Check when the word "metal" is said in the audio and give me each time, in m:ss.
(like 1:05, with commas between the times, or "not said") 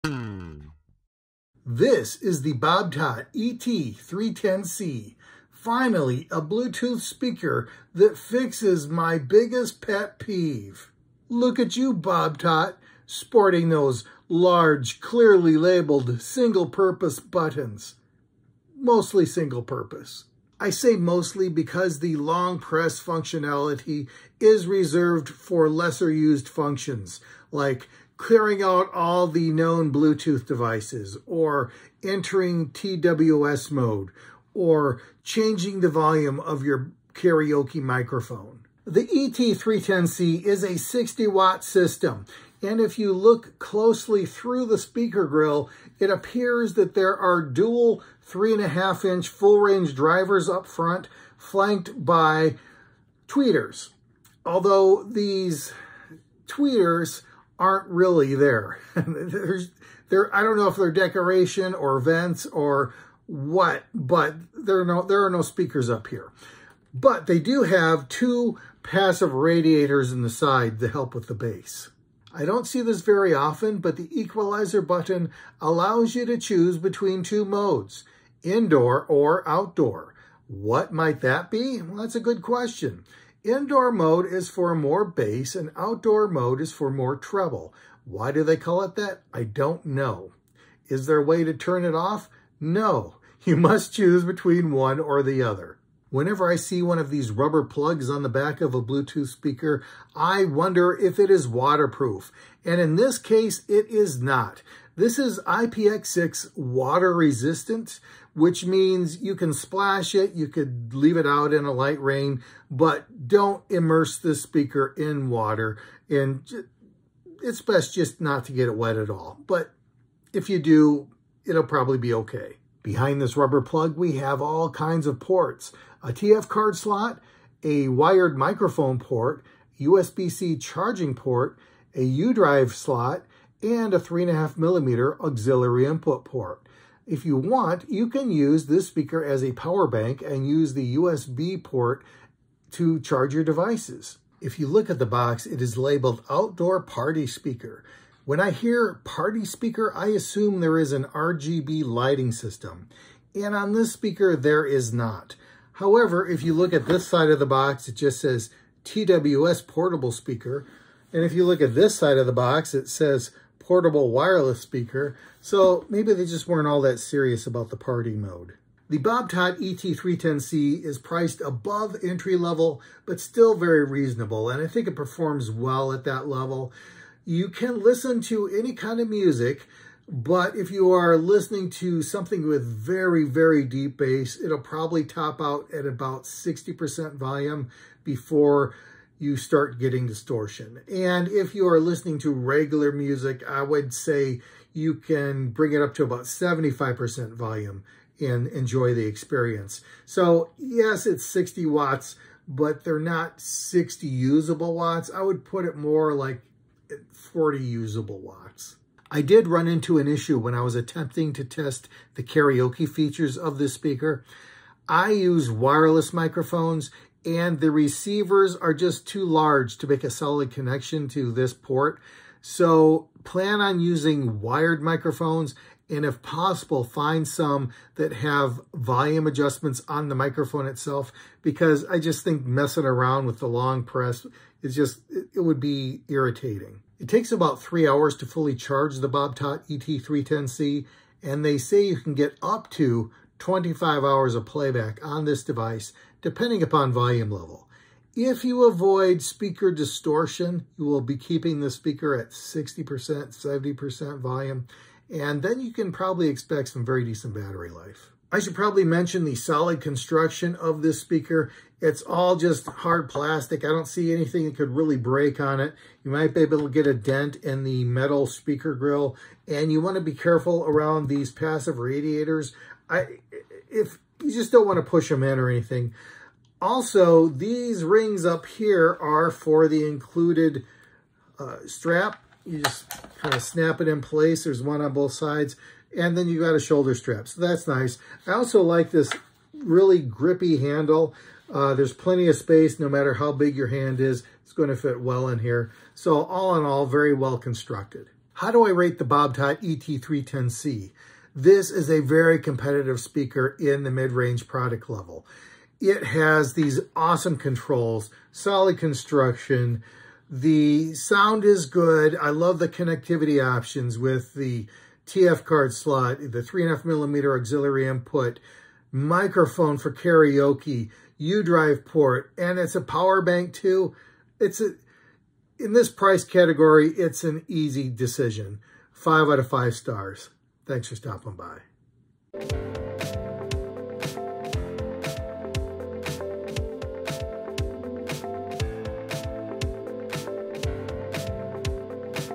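4:27.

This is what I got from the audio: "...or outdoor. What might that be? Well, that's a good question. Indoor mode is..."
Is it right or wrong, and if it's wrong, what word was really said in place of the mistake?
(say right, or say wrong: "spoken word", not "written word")
right.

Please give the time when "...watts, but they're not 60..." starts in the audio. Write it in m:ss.
3:21.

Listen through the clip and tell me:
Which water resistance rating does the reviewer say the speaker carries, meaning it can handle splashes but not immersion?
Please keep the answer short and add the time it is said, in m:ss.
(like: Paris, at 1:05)
IPX6, at 1:45.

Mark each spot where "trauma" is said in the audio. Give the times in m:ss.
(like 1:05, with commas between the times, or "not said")
not said.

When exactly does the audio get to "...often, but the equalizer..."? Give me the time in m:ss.
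1:13.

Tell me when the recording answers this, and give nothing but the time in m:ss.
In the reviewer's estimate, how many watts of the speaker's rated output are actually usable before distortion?
3:27.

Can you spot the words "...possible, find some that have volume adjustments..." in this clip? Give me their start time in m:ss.
3:46.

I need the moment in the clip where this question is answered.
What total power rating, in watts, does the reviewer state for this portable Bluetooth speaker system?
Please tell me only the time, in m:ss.
0:40.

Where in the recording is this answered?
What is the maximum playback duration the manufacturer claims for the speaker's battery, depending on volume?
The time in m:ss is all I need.
4:03.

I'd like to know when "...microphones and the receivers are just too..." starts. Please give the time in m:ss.
3:36.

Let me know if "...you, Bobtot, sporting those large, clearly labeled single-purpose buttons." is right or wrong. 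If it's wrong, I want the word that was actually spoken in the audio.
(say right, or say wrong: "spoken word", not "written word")
right.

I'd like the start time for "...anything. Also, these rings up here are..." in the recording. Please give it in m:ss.
4:35.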